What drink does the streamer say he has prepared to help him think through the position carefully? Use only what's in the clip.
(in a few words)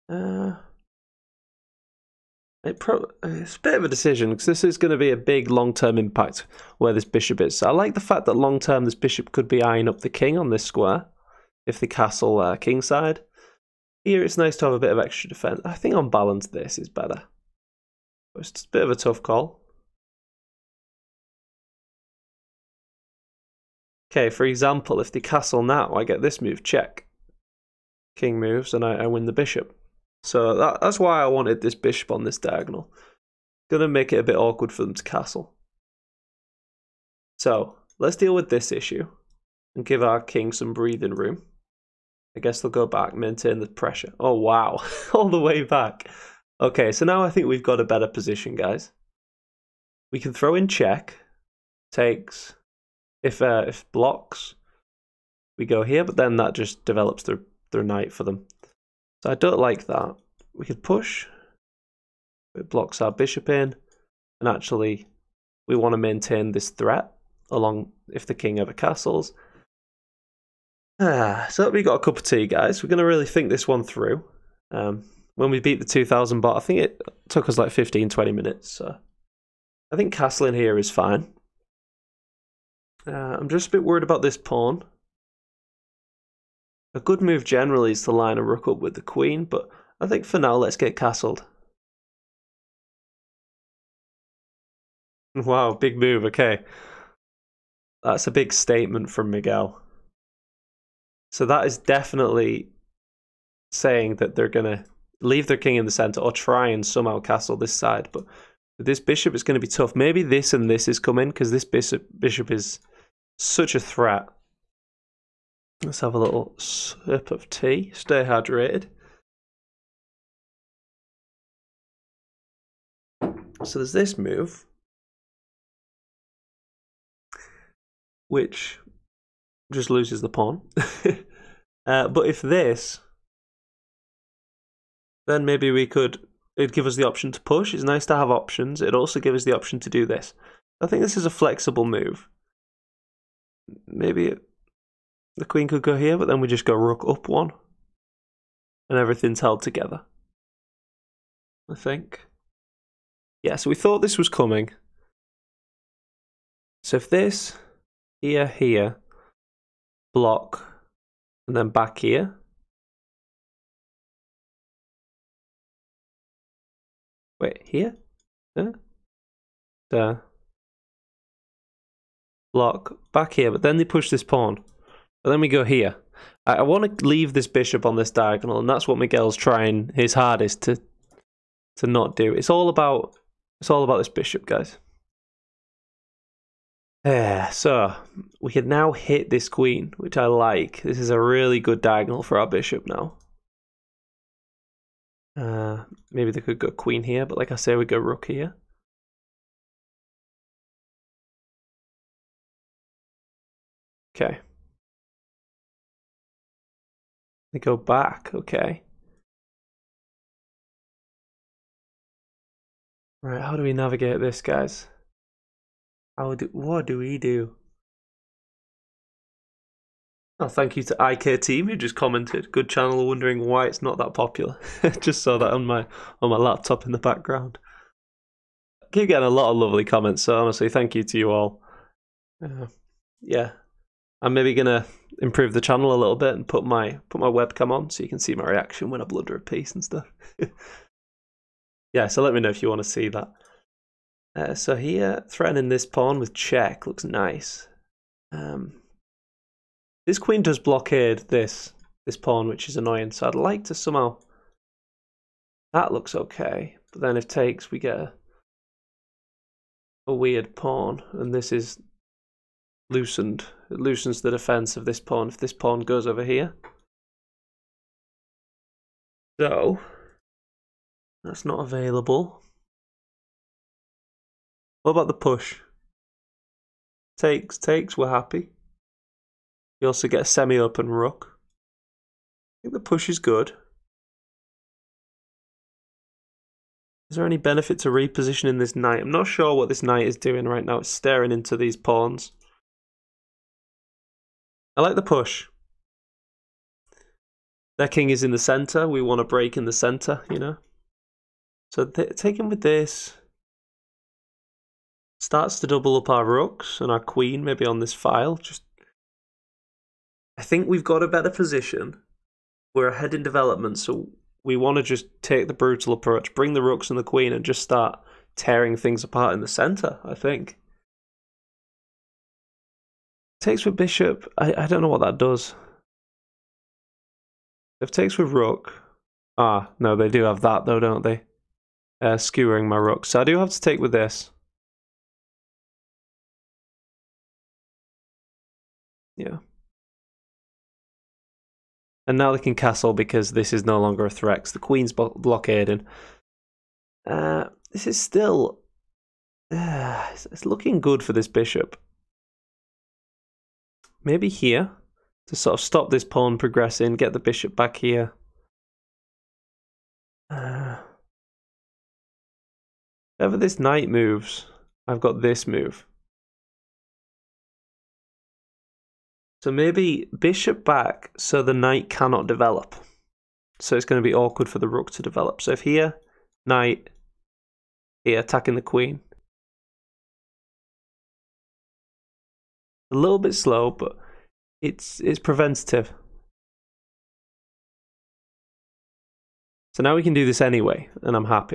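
cup of tea.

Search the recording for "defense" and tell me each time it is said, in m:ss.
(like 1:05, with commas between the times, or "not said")
0:15, 4:24.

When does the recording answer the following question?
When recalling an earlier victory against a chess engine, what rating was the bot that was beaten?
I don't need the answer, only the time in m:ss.
1:15.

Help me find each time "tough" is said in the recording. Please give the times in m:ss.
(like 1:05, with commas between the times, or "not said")
0:18, 1:49.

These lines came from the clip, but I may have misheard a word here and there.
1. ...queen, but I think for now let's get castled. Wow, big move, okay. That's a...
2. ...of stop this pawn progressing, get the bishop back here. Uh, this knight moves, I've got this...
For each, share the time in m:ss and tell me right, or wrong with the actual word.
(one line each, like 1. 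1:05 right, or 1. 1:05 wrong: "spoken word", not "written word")
1. 1:29 right
2. 5:55 right.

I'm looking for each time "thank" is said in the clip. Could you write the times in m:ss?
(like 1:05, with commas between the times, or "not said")
3:40, 3:50.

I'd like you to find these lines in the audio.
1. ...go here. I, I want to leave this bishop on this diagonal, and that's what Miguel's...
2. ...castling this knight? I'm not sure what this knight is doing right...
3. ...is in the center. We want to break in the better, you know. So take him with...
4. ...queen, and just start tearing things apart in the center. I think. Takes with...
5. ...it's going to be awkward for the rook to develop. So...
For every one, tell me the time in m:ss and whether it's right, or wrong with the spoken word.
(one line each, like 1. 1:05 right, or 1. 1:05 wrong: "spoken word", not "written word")
1. 2:55 right
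2. 4:47 wrong: "repositioning", not "castling"
3. 4:58 wrong: "center", not "better"
4. 5:17 right
5. 6:13 right.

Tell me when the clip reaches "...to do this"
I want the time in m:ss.
2:19.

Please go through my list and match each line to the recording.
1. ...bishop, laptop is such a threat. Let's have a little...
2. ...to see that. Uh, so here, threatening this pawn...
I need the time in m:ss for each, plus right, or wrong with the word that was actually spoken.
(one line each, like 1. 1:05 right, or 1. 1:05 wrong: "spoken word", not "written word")
1. 1:51 wrong: "bishop", not "laptop"
2. 4:02 right.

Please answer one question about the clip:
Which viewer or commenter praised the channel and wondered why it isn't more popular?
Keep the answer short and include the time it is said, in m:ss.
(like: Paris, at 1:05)
IK Team, at 3:41.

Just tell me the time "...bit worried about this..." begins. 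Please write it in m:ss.
1:23.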